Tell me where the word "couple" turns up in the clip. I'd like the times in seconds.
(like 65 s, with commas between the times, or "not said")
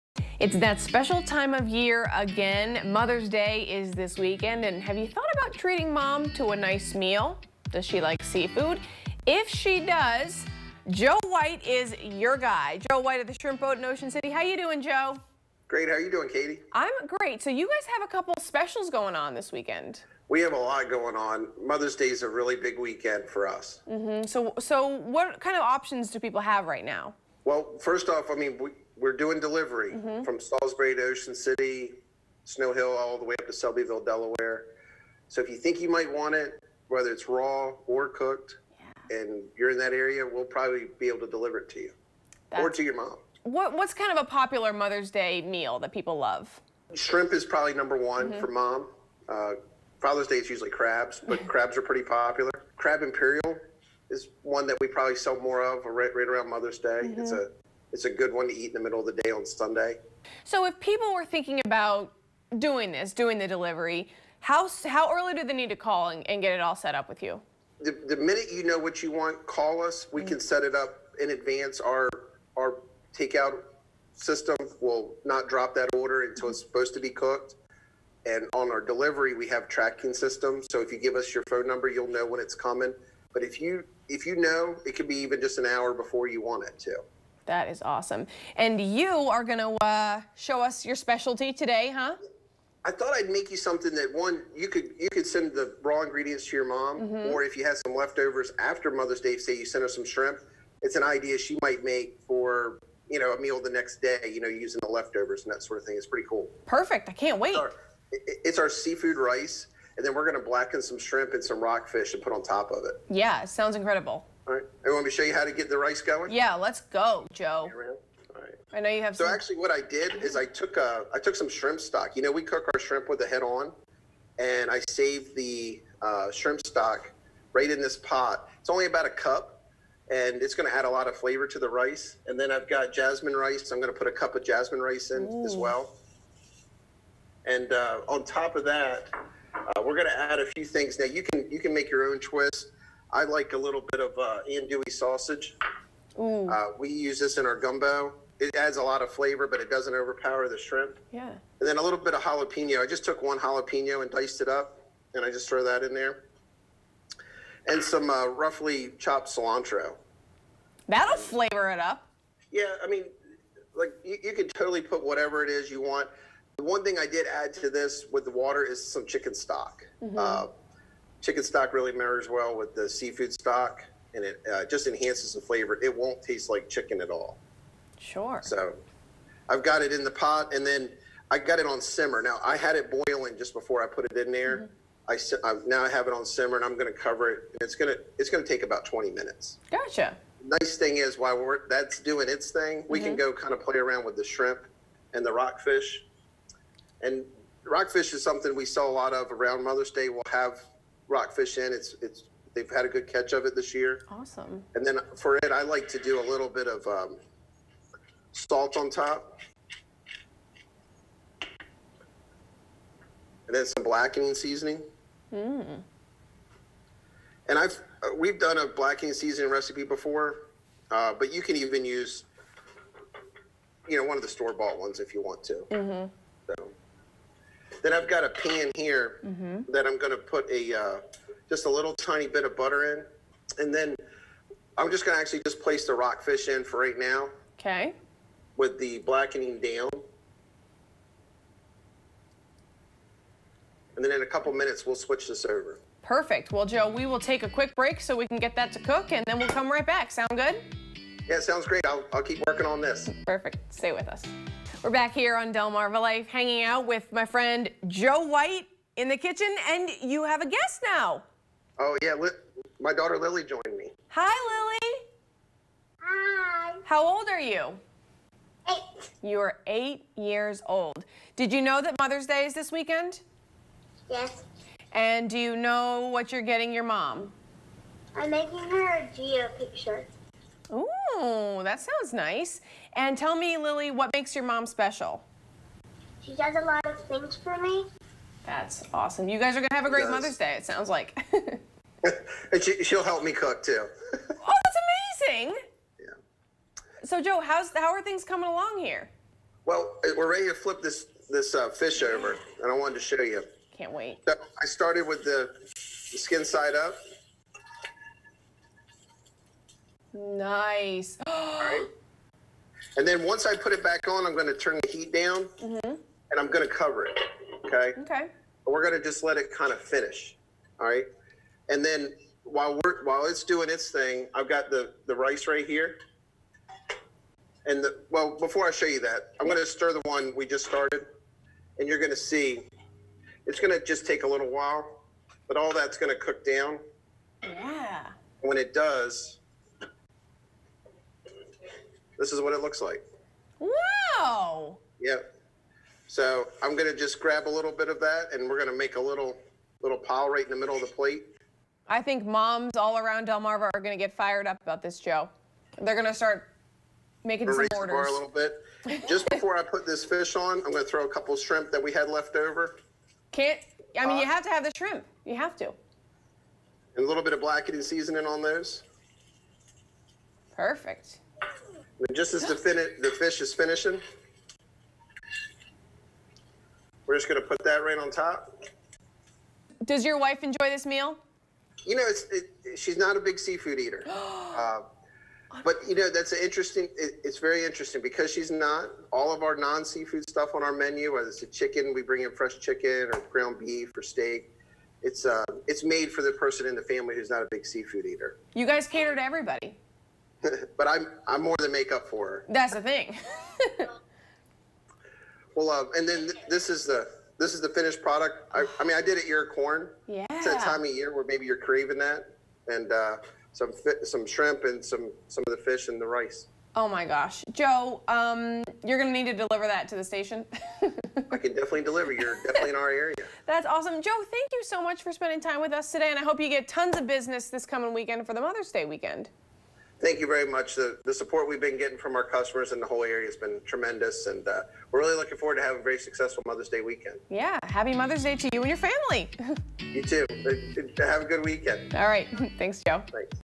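18 s, 244 s, 361 s.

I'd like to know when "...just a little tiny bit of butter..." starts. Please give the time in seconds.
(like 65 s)
231 s.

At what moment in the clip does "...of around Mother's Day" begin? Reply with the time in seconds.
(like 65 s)
199 s.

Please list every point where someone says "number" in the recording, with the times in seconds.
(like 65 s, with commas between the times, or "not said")
47 s, 81 s.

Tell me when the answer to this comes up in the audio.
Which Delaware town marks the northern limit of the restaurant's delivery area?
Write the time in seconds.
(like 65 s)
33 s.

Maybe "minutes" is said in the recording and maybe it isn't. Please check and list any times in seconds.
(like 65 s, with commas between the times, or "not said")
68 s, 189 s, 244 s.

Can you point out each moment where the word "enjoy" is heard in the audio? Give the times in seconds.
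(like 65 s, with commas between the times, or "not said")
380 s.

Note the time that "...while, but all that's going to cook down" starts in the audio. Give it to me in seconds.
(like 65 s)
334 s.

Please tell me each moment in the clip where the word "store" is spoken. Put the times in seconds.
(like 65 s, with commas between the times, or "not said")
224 s.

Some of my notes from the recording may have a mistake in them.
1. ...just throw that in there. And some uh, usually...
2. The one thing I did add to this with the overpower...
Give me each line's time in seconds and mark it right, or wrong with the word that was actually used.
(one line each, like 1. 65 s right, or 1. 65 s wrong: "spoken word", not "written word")
1. 155 s wrong: "roughly", not "usually"
2. 166 s wrong: "water", not "overpower".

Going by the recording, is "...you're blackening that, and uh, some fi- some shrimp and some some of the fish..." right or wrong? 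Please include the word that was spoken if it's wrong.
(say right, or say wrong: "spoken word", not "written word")
wrong: "craving", not "blackening".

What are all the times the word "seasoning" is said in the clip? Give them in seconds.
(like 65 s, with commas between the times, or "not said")
214 s, 219 s, 367 s.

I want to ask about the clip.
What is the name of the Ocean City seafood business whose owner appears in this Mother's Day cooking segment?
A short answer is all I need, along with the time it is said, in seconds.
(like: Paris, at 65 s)
Shrimp Boat, at 13 s.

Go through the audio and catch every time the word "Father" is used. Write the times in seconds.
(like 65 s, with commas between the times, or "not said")
49 s.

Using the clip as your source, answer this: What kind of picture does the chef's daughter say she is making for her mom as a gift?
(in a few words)
Geo picture.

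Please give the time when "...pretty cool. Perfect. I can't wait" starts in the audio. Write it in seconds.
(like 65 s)
106 s.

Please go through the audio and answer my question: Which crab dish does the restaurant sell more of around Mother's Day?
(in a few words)
Crab Imperial.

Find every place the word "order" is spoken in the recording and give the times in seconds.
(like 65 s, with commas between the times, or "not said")
75 s, 357 s.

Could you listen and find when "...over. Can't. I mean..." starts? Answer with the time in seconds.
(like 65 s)
362 s.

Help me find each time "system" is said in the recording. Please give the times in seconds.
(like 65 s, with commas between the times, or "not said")
74 s, 80 s.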